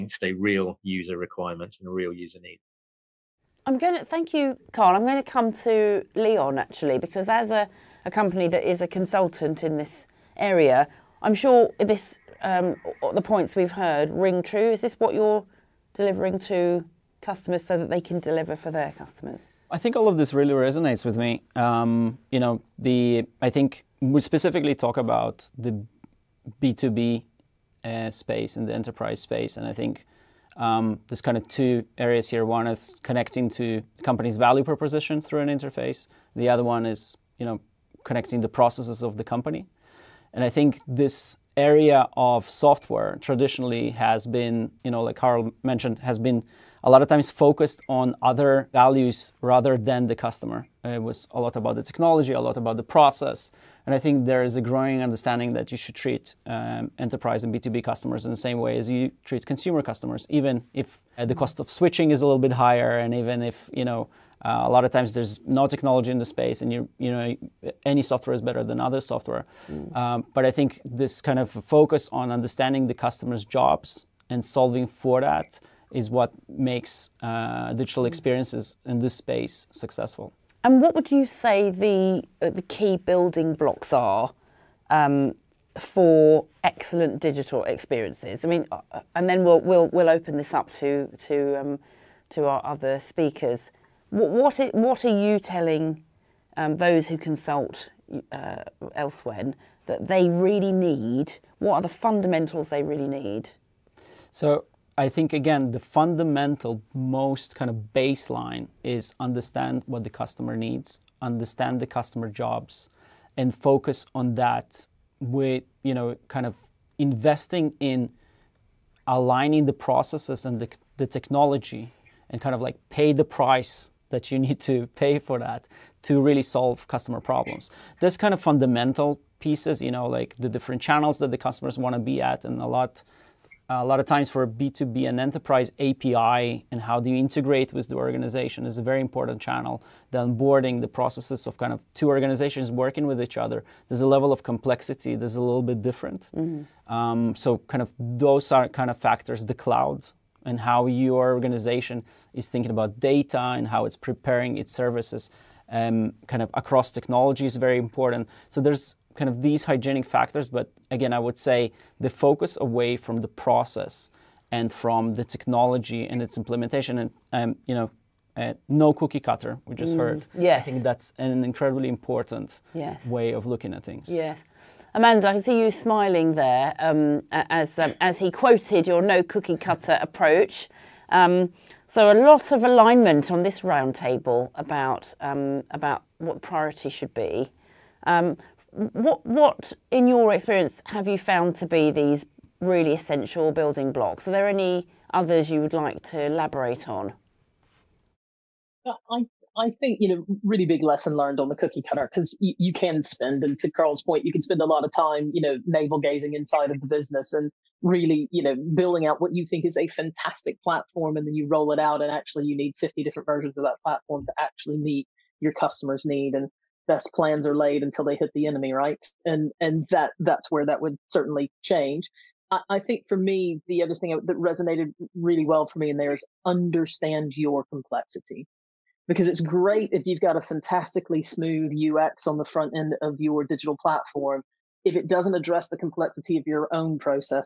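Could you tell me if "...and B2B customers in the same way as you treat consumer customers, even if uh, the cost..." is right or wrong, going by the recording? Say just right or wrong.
right.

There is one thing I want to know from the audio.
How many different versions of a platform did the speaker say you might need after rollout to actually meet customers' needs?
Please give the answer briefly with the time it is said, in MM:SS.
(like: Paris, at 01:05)
50, at 03:32.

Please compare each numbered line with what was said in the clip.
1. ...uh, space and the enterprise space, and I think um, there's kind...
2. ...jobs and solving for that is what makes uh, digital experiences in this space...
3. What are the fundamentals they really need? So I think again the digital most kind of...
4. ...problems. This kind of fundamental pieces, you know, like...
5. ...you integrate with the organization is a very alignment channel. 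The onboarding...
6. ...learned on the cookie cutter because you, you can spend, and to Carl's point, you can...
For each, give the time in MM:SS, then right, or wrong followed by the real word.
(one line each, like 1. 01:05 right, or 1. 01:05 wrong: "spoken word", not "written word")
1. 00:27 right
2. 01:13 right
3. 01:41 wrong: "fundamental", not "digital"
4. 02:07 right
5. 02:17 wrong: "important", not "alignment"
6. 03:21 right.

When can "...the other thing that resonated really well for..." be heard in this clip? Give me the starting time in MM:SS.
03:43.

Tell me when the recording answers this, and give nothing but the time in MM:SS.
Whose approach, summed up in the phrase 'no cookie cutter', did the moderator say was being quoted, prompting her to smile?
02:54.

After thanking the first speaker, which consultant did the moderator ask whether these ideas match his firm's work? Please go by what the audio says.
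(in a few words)
Leon.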